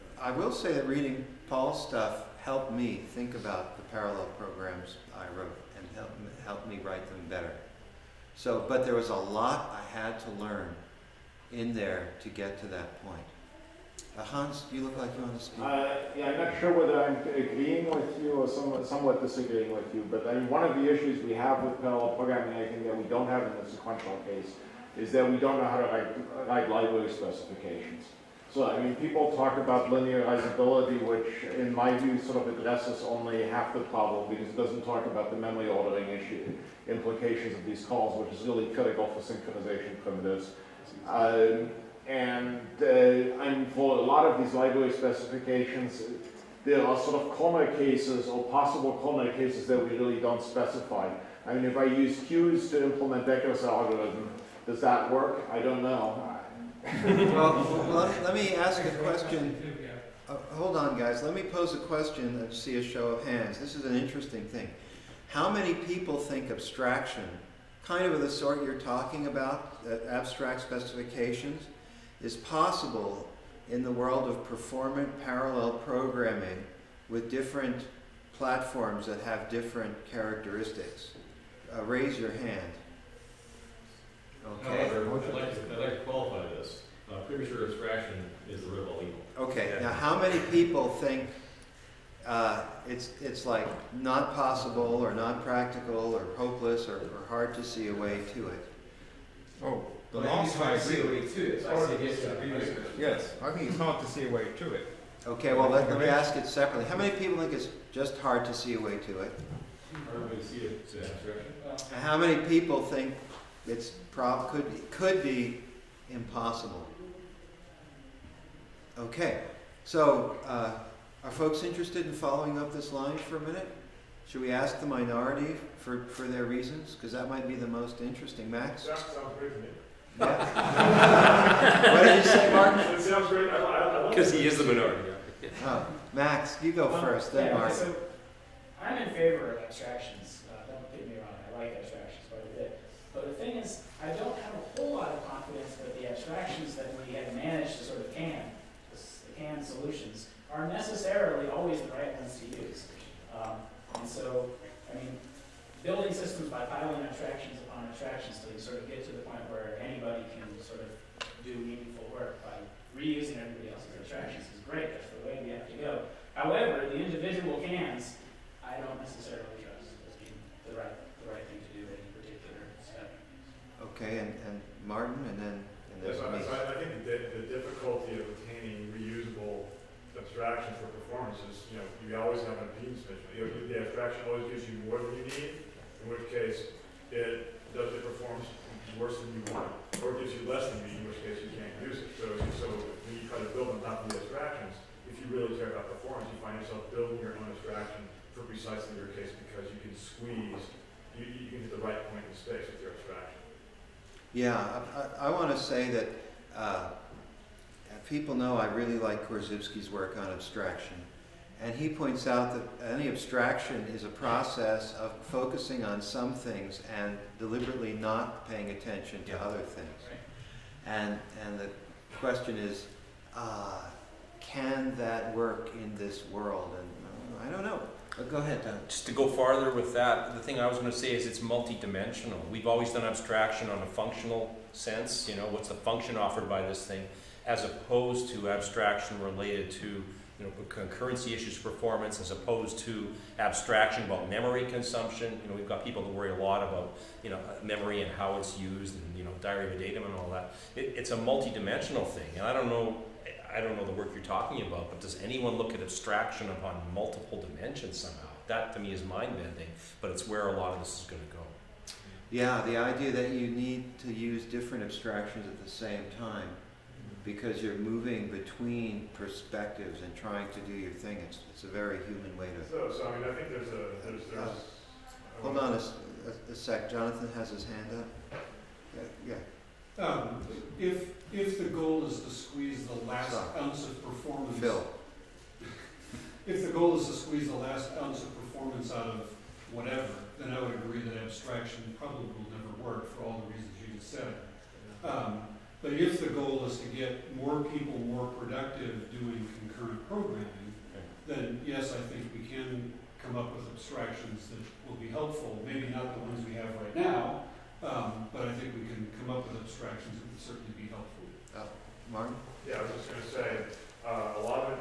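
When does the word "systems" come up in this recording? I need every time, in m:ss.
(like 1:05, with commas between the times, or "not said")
2:36.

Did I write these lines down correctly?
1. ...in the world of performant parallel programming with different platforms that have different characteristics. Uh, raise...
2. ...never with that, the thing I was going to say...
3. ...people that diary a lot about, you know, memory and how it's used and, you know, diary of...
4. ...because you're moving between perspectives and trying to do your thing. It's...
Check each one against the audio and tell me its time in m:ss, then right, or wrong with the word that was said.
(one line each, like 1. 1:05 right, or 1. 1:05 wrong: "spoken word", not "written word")
1. 1:13 right
2. 3:49 wrong: "farther", not "never"
3. 4:05 wrong: "worry", not "diary"
4. 4:27 right.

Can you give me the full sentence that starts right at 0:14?
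Uh, Hans, you look like you want to speak.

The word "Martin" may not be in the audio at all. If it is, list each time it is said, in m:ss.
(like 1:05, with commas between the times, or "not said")
2:54, 5:12.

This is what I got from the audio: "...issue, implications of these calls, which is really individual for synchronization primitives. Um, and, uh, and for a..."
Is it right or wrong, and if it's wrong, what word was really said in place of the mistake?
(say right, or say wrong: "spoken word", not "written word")
wrong: "critical", not "individual".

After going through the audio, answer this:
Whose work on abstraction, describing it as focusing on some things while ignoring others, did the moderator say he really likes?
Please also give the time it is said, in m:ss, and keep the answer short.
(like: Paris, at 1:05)
Korzybski, at 3:29.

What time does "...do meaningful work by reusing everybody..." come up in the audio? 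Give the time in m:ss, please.
2:41.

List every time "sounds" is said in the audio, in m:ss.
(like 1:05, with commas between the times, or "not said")
2:08, 2:13.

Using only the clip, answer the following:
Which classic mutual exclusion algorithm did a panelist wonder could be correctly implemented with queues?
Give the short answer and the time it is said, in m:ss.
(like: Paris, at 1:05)
Dekker's algorithm, at 0:53.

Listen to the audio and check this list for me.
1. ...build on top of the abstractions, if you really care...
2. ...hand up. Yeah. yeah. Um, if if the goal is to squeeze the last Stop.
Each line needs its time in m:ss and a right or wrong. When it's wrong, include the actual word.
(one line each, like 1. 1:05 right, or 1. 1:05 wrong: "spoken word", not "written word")
1. 3:13 right
2. 4:37 right.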